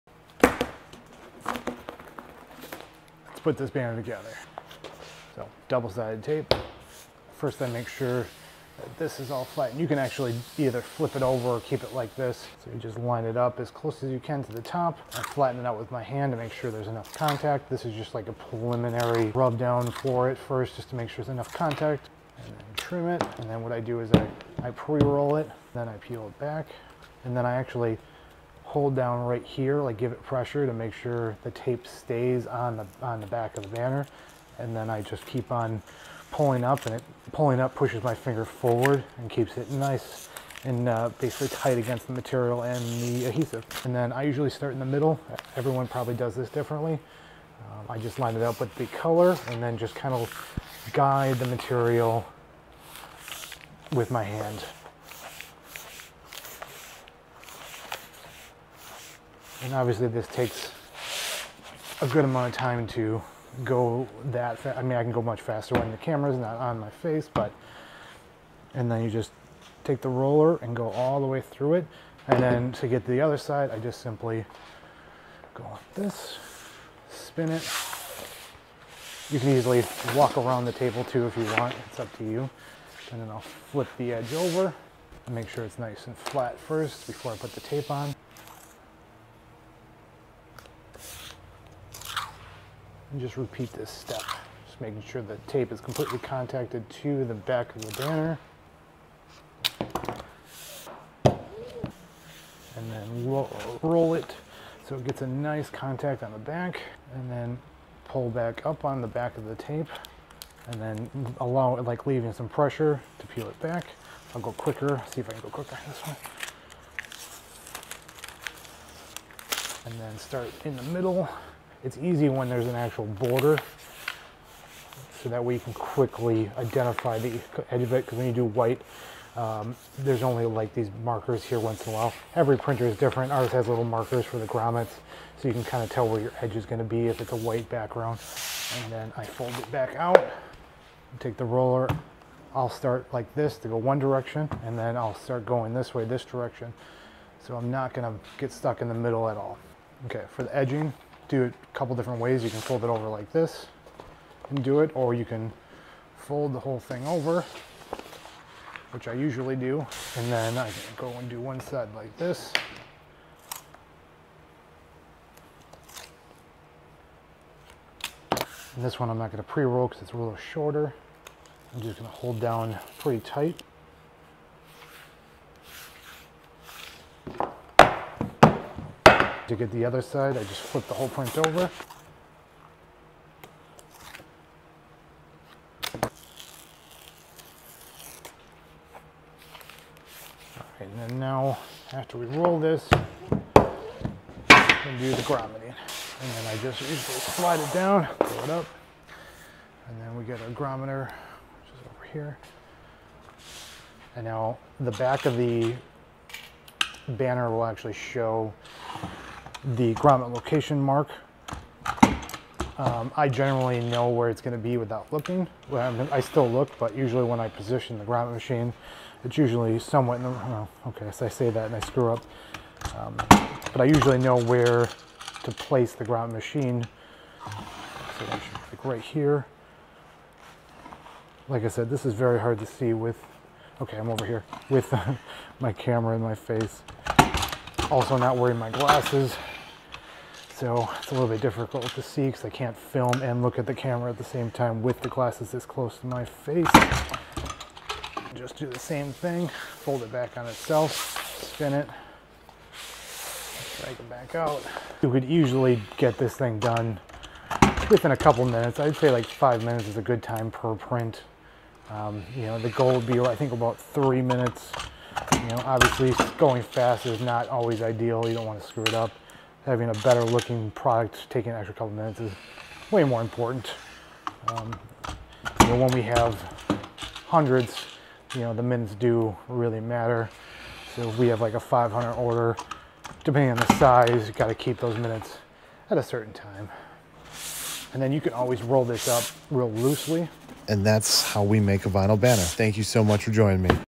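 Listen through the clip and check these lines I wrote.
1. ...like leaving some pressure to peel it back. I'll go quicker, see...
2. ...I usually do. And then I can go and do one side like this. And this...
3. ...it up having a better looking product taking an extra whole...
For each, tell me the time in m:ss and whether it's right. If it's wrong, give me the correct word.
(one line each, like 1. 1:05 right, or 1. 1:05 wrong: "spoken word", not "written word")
1. 1:51 right
2. 2:39 right
3. 4:28 wrong: "couple", not "whole".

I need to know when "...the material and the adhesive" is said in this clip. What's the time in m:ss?
0:42.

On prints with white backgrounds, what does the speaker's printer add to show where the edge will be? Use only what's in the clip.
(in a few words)
Markers for the grommets.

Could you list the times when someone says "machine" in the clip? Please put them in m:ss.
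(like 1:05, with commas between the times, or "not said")
3:38, 3:46.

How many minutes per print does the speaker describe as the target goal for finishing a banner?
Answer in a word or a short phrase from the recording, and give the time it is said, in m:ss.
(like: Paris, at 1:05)
3, at 4:23.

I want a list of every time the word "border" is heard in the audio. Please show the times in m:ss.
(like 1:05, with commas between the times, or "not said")
2:03.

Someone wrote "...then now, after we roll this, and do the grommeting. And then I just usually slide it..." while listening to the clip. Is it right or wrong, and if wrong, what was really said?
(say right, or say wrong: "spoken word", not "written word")
right.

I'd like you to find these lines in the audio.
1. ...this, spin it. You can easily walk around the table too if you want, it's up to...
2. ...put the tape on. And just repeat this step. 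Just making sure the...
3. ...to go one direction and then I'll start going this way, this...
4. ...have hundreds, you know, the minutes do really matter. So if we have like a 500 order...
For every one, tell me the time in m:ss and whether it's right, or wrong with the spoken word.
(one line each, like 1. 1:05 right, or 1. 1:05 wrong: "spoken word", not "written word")
1. 1:15 right
2. 1:27 right
3. 2:23 right
4. 4:36 right.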